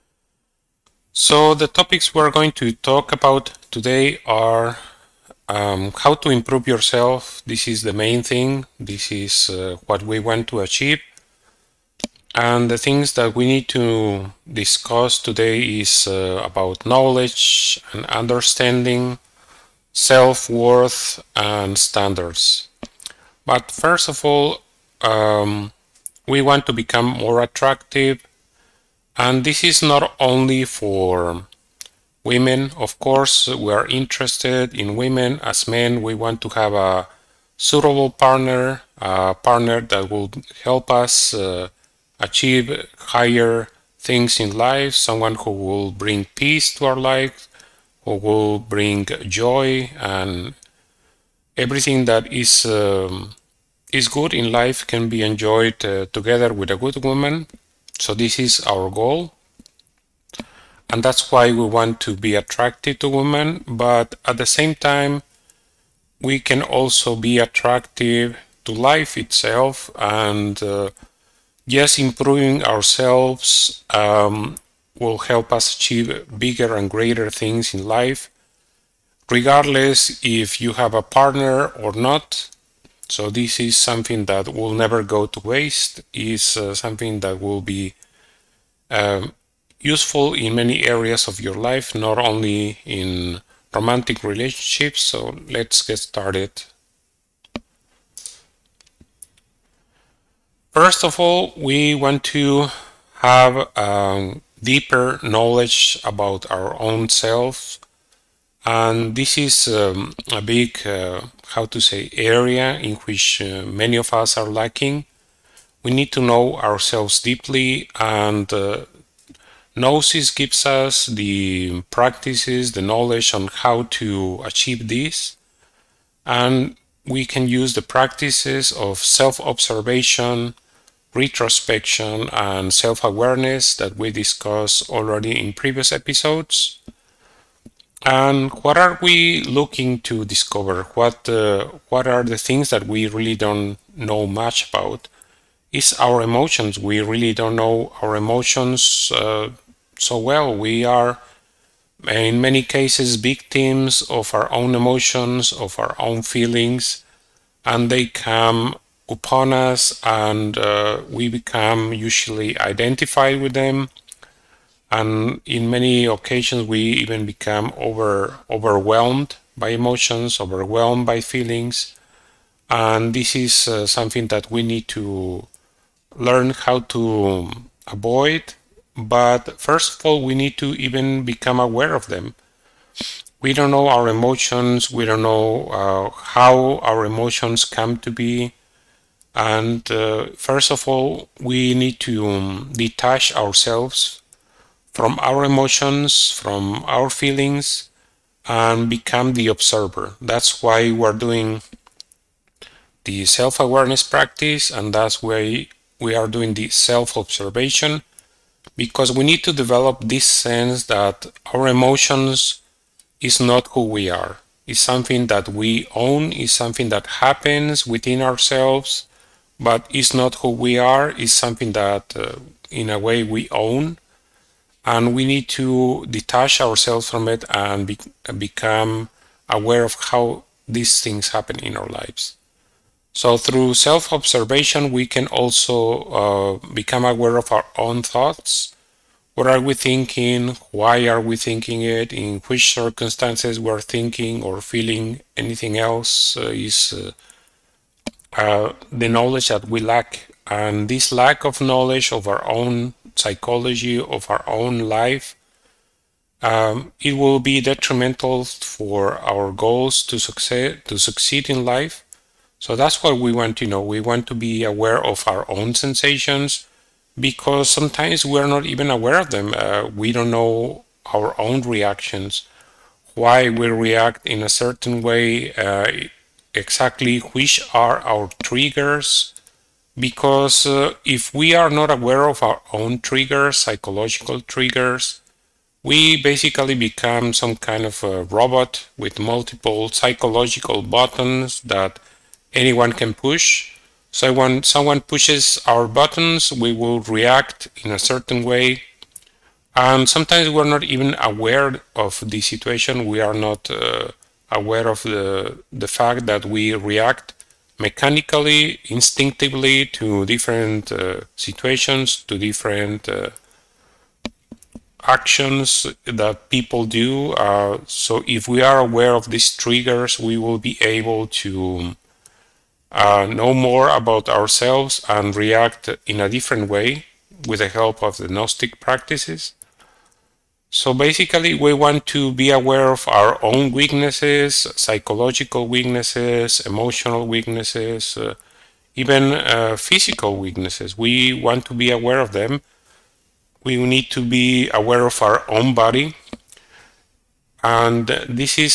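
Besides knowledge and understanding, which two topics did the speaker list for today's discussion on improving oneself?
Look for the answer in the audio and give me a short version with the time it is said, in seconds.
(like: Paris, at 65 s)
Self-worth and standards, at 19 s.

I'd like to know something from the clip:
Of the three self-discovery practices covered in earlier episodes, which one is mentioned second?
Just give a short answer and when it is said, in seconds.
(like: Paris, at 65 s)
Retrospection, at 131 s.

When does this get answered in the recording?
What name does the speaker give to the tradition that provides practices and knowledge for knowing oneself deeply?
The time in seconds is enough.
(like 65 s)
119 s.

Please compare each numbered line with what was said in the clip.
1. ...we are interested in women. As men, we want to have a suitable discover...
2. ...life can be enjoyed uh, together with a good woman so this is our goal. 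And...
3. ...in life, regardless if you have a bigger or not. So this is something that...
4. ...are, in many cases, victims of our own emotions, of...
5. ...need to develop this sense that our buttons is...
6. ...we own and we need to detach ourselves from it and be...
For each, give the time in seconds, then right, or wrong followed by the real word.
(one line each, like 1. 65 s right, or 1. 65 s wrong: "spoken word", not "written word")
1. 33 s wrong: "partner", not "discover"
2. 54 s right
3. 77 s wrong: "partner", not "bigger"
4. 150 s right
5. 209 s wrong: "emotions", not "buttons"
6. 223 s right.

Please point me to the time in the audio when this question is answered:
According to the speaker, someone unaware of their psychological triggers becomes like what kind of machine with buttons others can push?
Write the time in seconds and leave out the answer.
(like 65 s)
288 s.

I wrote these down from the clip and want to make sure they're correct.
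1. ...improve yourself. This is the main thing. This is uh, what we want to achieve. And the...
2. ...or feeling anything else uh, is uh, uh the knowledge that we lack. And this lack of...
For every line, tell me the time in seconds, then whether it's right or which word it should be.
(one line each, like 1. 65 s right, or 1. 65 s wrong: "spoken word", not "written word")
1. 6 s right
2. 244 s right.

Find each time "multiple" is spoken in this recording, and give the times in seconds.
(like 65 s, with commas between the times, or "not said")
289 s.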